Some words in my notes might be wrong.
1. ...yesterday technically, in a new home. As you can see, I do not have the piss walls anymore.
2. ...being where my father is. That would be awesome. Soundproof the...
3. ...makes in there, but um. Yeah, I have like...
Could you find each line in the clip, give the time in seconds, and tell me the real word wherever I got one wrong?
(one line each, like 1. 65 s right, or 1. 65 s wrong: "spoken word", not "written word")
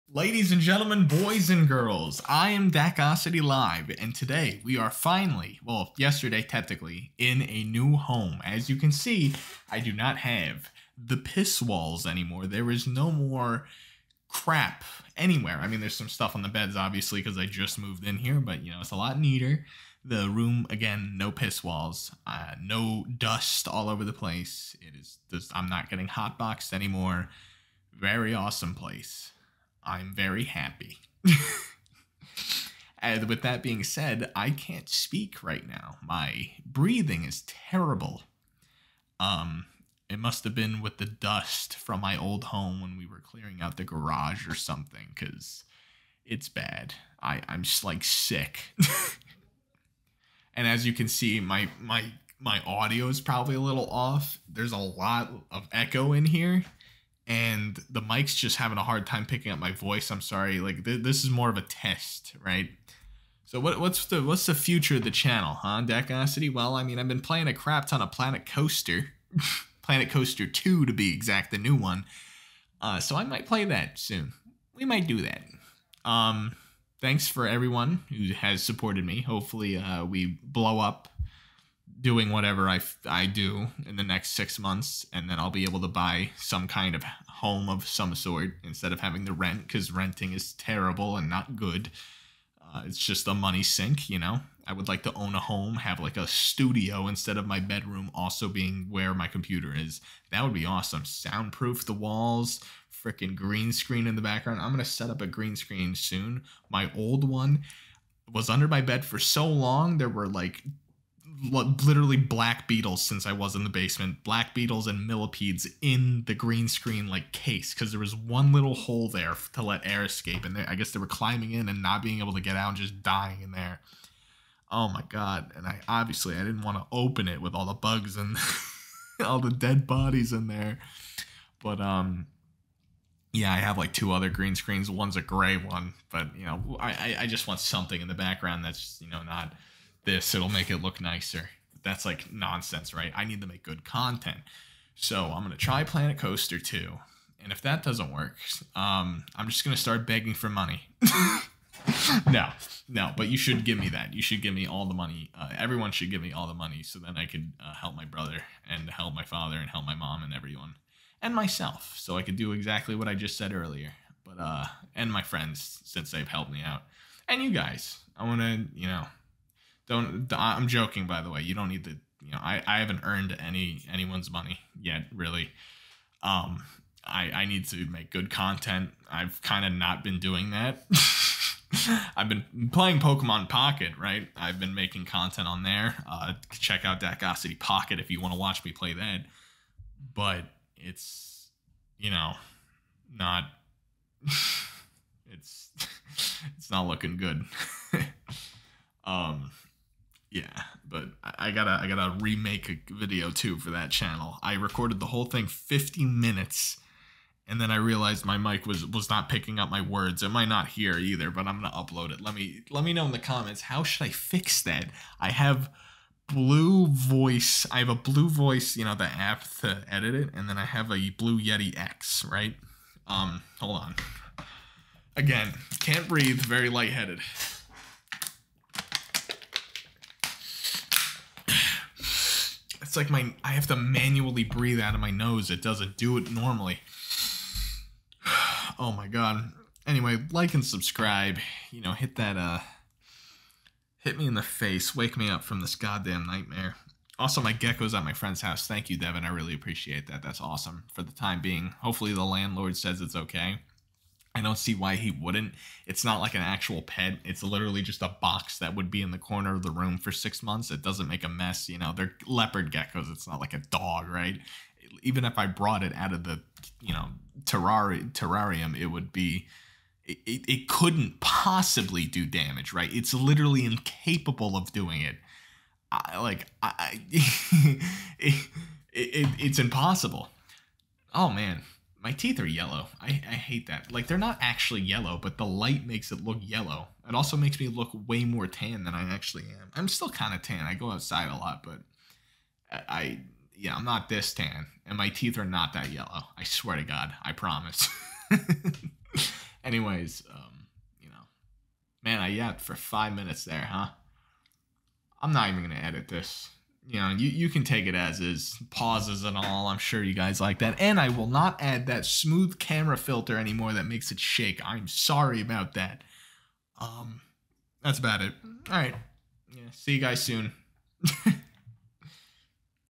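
1. 5 s right
2. 98 s wrong: "computer", not "father"
3. 129 s wrong: "bodies", not "makes".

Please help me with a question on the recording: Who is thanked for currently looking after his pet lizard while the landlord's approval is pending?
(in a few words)
Devin.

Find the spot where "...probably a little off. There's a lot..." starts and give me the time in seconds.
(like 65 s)
53 s.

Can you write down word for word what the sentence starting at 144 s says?
So I'm going to try Planet Coaster 2.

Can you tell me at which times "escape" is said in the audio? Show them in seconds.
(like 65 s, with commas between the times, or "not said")
120 s.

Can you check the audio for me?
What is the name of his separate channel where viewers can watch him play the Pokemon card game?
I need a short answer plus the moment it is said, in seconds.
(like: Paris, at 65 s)
Dakocity Pocket, at 187 s.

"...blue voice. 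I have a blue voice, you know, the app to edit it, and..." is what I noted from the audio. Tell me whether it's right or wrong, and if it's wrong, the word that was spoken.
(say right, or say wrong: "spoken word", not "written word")
right.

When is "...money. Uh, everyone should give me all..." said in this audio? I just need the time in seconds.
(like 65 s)
154 s.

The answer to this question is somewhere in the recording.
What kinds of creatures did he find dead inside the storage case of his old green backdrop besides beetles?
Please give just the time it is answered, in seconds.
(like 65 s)
115 s.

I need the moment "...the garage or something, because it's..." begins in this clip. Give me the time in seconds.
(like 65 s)
43 s.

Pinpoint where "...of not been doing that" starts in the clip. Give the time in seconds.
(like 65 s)
179 s.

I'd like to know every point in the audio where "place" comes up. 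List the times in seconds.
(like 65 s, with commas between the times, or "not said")
24 s, 28 s.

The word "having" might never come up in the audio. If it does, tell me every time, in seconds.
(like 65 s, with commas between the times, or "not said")
58 s, 88 s.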